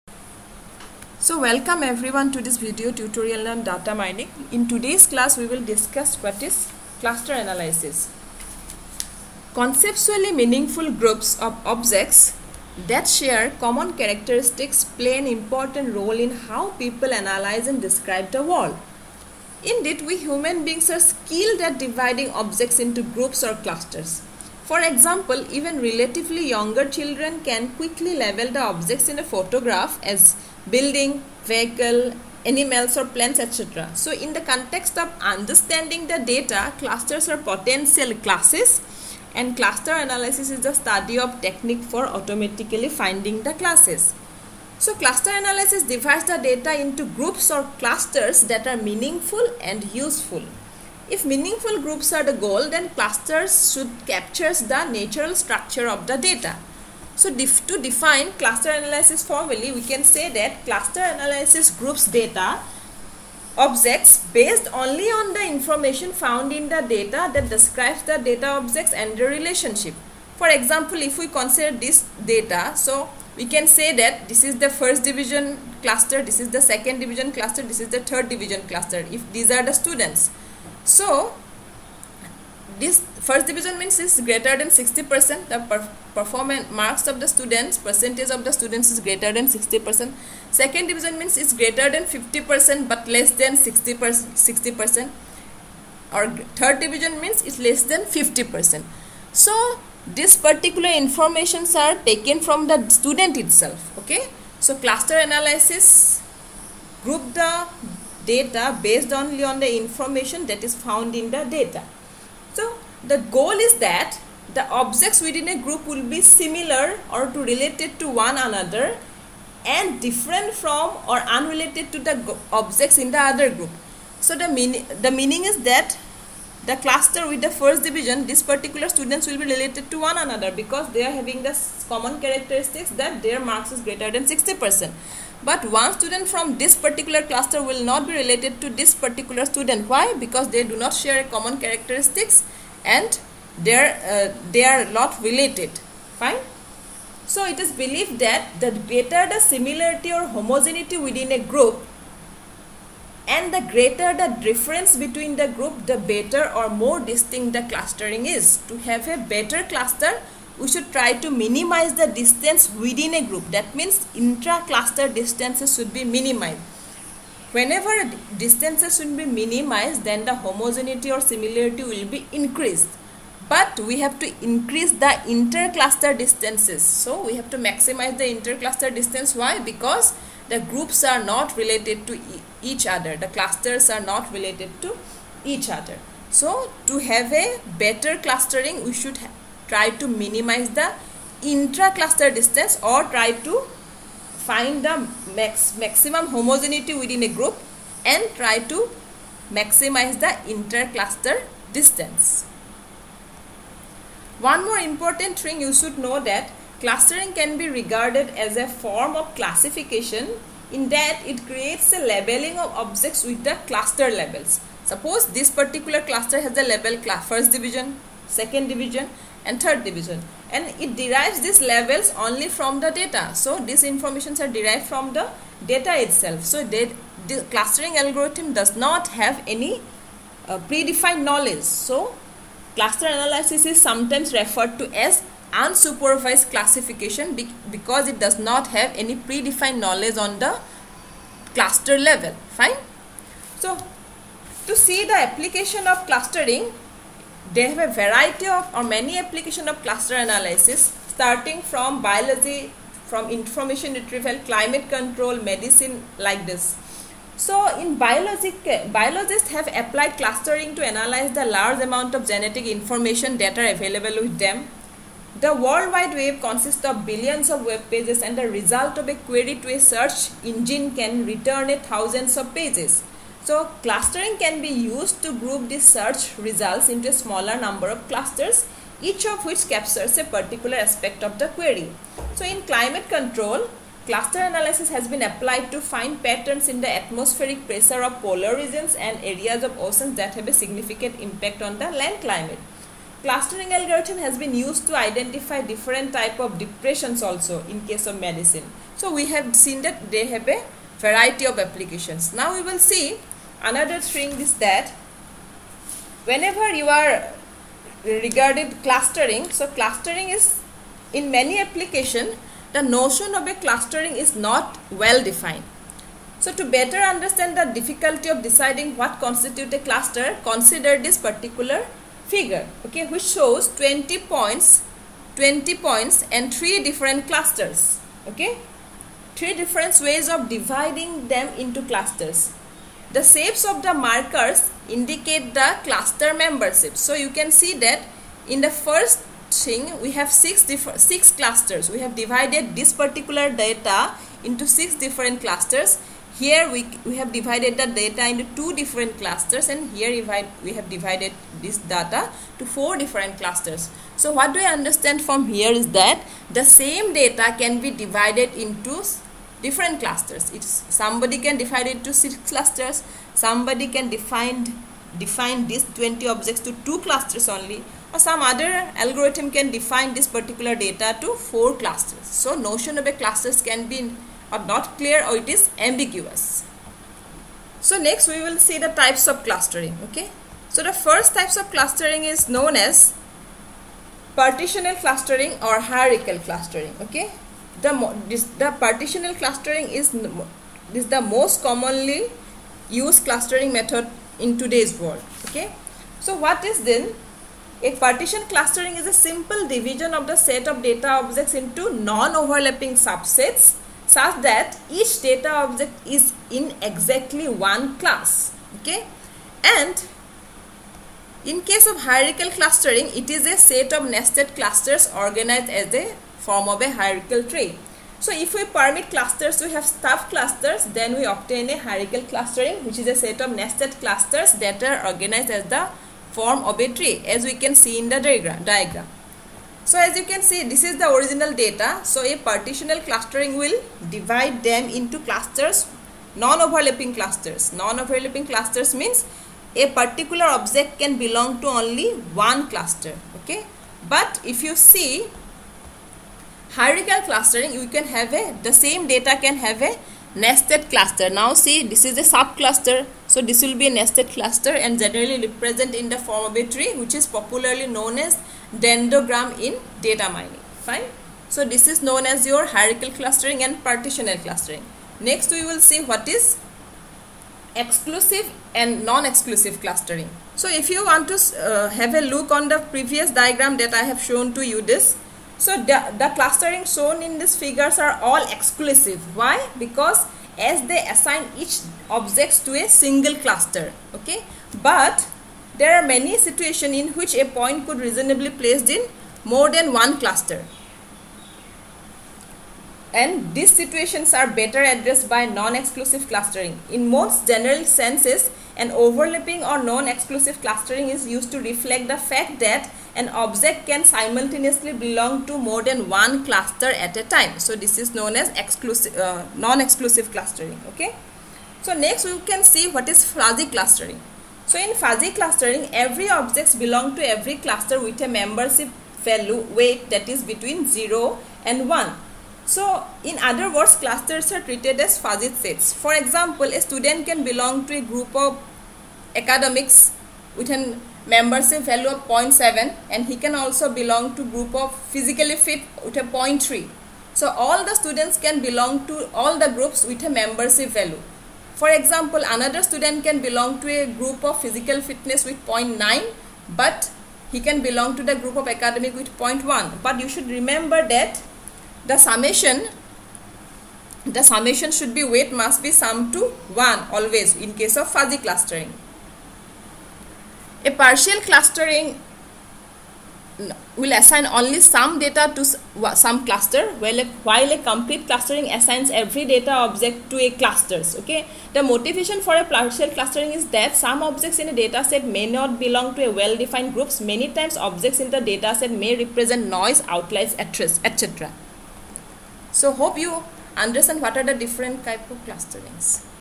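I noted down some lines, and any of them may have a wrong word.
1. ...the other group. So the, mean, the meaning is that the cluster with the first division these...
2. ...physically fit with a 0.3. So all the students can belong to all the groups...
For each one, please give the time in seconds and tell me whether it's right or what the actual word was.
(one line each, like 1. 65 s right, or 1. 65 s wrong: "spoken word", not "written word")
1. 123 s right
2. 535 s right.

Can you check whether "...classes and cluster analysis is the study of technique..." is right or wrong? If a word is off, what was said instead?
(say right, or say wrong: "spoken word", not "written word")
right.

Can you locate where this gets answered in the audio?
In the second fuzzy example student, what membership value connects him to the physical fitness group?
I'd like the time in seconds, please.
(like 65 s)
545 s.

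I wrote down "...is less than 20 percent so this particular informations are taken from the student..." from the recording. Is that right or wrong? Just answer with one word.
wrong.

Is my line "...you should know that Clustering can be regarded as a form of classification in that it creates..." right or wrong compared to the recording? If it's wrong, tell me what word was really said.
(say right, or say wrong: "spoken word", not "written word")
right.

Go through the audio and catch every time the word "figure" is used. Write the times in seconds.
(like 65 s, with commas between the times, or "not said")
322 s, 477 s.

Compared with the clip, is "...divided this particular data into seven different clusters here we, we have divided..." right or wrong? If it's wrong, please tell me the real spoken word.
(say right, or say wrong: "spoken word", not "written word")
wrong: "six", not "seven".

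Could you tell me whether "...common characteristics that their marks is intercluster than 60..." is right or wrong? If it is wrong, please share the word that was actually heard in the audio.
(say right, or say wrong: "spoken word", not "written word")
wrong: "greater", not "intercluster".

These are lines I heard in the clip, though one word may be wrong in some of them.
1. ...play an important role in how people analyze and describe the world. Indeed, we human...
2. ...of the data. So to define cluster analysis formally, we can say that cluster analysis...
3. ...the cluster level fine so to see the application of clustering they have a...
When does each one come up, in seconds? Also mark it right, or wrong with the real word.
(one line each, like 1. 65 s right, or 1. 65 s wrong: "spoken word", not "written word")
1. 14 s right
2. 55 s right
3. 240 s right.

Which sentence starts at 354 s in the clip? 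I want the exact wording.
So what do I understand from here is that the same data can be divided into different clusters.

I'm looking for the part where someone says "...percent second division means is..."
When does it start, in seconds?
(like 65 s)
89 s.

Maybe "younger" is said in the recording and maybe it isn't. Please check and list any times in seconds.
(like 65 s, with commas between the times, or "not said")
26 s.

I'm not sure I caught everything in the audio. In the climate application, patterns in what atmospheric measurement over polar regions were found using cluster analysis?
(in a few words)
atmospheric pressure.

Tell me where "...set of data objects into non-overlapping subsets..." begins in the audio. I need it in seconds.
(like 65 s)
400 s.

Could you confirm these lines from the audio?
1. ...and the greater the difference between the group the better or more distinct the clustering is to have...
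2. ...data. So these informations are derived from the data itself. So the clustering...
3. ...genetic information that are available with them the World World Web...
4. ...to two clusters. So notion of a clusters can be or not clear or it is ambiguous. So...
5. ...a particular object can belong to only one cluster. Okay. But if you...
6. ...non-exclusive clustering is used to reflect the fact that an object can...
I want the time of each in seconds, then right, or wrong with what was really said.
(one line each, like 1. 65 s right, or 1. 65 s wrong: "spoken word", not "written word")
1. 153 s right
2. 222 s right
3. 262 s wrong: "Wide", not "World"
4. 371 s wrong: "four", not "two"
5. 439 s right
6. 499 s right.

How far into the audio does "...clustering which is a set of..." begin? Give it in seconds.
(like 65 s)
422 s.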